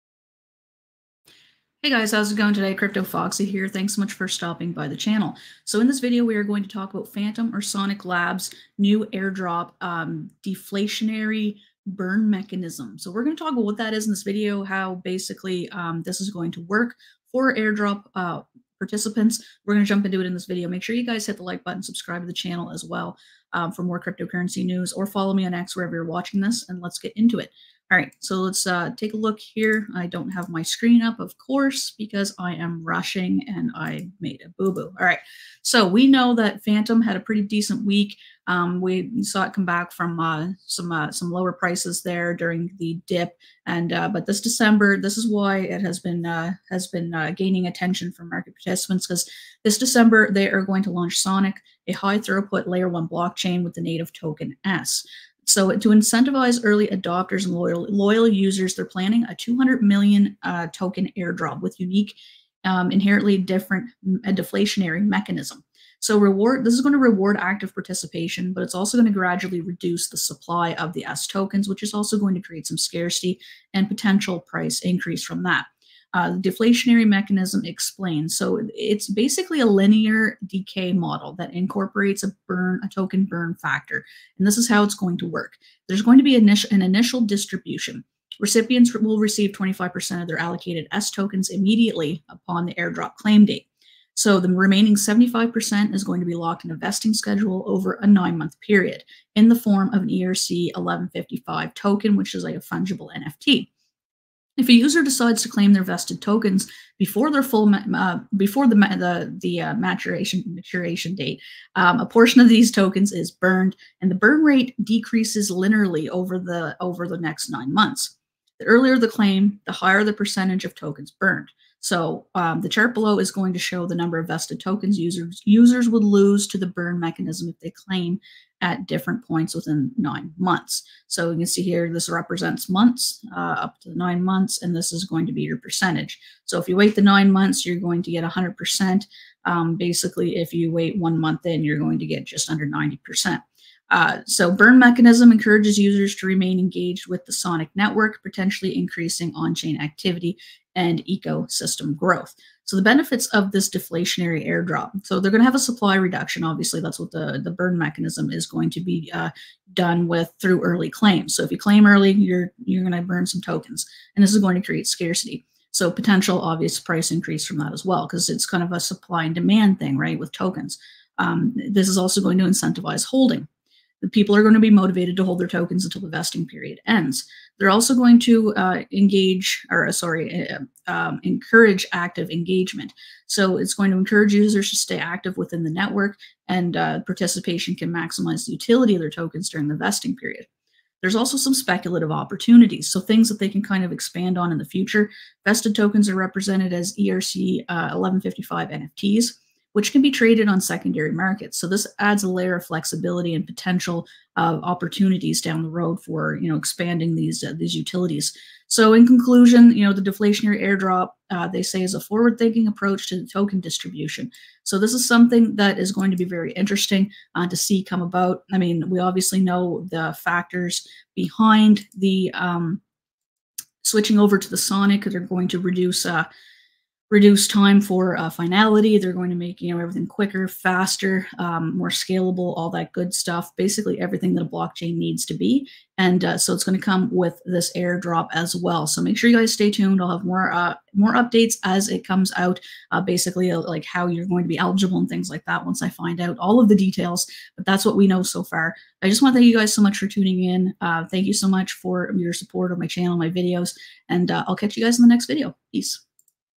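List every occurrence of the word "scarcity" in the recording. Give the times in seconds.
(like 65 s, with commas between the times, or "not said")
72 s, 164 s.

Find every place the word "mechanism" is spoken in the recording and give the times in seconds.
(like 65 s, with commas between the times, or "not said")
12 s, 65 s, 77 s, 126 s, 144 s, 157 s.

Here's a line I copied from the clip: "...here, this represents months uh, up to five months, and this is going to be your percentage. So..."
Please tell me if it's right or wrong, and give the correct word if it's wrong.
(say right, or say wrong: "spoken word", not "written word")
wrong: "nine", not "five".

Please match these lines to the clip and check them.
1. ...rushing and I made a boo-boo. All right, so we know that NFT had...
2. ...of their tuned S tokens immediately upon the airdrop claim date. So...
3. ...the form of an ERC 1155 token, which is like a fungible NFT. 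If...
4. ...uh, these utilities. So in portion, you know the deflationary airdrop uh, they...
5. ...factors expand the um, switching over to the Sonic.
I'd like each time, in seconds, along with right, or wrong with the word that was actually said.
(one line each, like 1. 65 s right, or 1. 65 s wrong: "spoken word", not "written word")
1. 32 s wrong: "Fantom", not "NFT"
2. 90 s wrong: "allocated", not "tuned"
3. 99 s right
4. 207 s wrong: "conclusion", not "portion"
5. 220 s wrong: "behind", not "expand".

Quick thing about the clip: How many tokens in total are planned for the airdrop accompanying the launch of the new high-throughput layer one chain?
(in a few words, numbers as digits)
200 million.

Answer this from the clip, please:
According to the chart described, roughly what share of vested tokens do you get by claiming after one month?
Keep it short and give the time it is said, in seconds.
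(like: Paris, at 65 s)
just under 90%, at 142 s.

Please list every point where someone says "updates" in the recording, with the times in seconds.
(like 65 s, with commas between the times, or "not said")
241 s.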